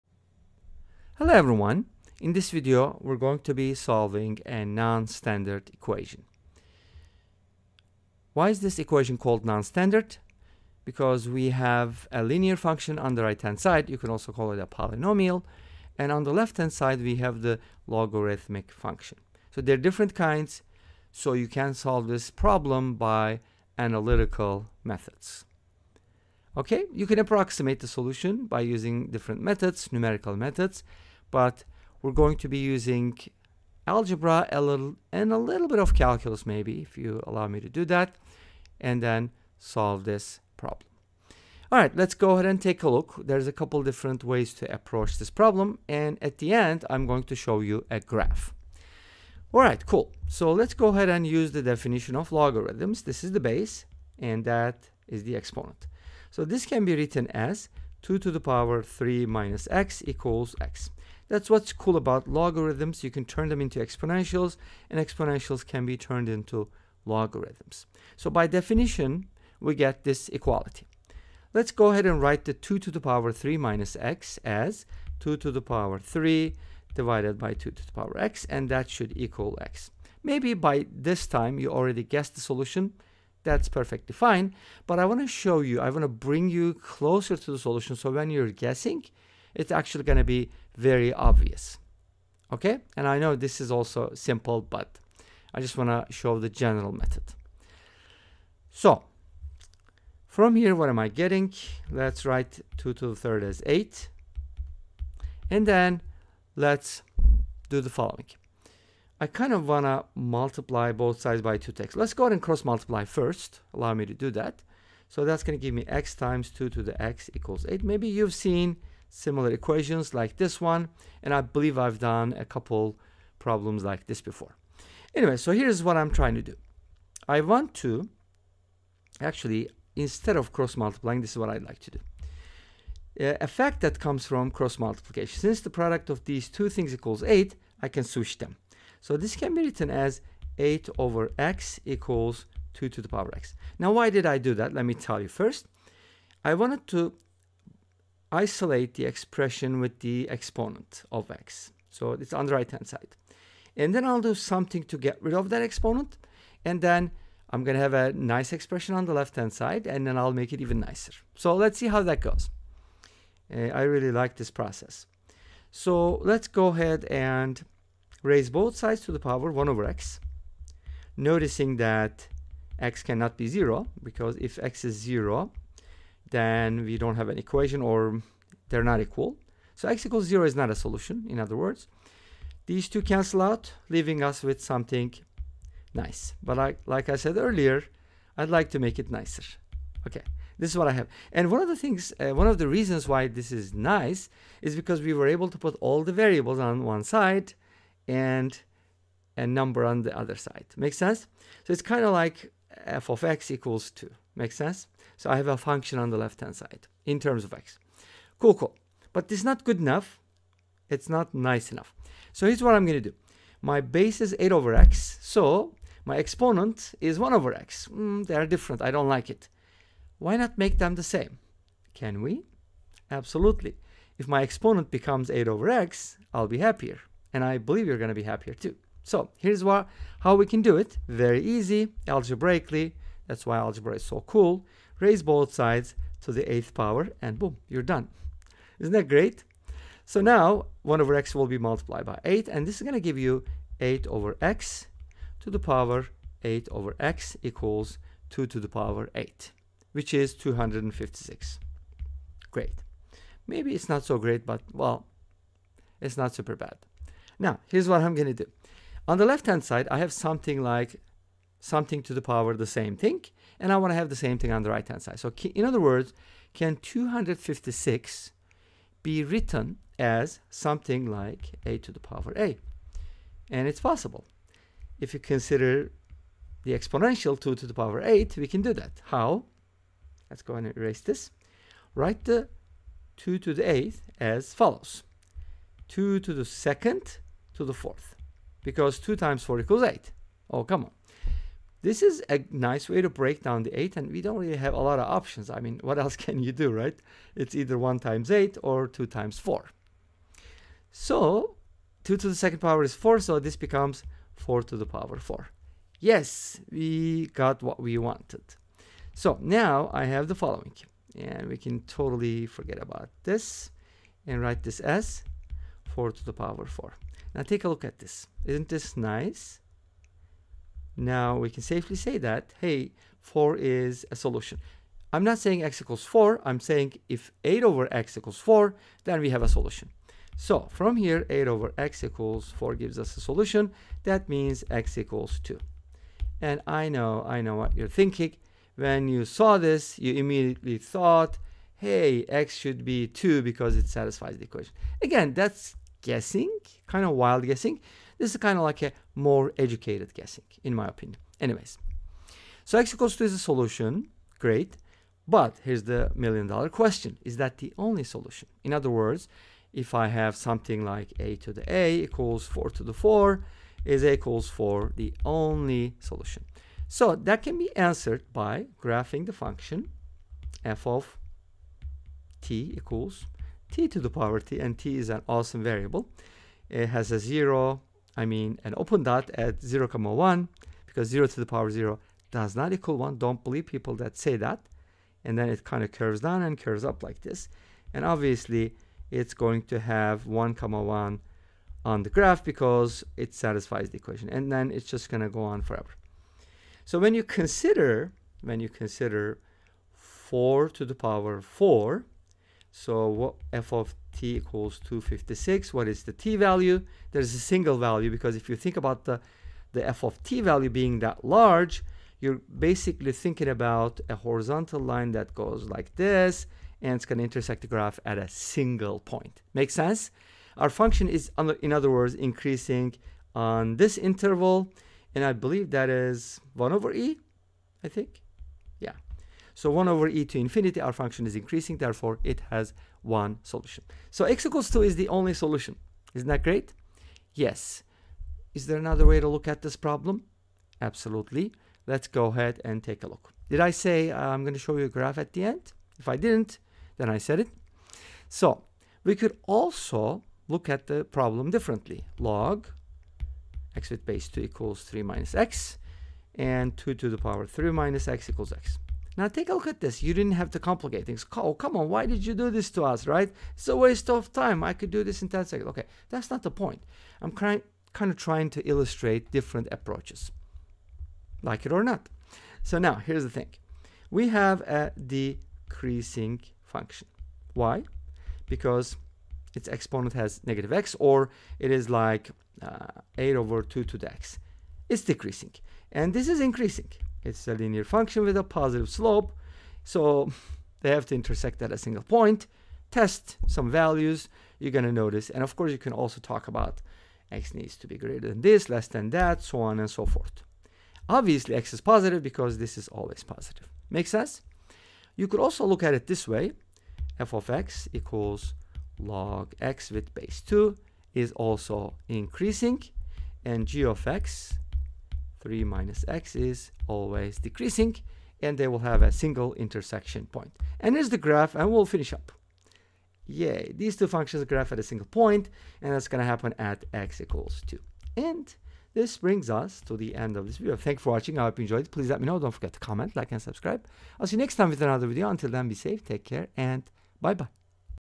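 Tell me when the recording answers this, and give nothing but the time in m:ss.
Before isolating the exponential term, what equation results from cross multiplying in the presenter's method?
1:55.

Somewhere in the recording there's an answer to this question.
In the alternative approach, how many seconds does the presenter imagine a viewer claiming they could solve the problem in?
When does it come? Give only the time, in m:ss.
7:45.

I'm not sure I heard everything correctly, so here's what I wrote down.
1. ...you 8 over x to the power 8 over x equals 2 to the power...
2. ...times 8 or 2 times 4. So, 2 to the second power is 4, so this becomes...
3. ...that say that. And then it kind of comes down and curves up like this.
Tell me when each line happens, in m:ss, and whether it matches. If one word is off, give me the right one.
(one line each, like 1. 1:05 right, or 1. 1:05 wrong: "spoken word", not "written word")
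1. 4:03 right
2. 4:57 right
3. 6:23 wrong: "curves", not "comes".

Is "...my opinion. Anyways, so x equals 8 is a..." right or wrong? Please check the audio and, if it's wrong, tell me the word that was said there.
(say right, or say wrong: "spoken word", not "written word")
wrong: "2", not "8".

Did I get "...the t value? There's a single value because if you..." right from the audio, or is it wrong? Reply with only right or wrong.
right.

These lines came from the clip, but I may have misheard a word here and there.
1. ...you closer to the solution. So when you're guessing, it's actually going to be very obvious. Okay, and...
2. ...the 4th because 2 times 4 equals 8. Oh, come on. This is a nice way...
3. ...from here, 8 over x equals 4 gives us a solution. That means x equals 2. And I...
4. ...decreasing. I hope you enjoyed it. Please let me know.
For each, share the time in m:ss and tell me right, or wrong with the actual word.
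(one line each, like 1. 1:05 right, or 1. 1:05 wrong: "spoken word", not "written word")
1. 1:26 right
2. 4:47 right
3. 5:30 right
4. 8:51 wrong: "watching", not "decreasing".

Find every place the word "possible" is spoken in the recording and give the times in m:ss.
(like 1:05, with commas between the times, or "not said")
4:33.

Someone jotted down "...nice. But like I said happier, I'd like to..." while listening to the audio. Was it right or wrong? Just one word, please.
wrong.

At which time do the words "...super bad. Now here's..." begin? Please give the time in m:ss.
4:16.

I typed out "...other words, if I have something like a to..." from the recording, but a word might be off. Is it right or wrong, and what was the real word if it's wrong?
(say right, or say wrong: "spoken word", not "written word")
right.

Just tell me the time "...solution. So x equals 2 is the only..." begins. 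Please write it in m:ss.
7:13.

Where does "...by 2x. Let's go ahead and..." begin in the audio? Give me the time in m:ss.
1:51.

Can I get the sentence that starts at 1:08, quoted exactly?
So by definition, we get this equality.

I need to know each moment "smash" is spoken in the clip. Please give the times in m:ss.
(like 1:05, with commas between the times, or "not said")
not said.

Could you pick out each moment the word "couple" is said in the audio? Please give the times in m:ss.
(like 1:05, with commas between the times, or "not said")
0:43, 2:02.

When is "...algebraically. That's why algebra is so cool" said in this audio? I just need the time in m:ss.
3:52.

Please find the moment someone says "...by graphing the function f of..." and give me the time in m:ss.
6:08.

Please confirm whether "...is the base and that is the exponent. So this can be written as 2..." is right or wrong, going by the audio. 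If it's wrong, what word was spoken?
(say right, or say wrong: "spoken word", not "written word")
right.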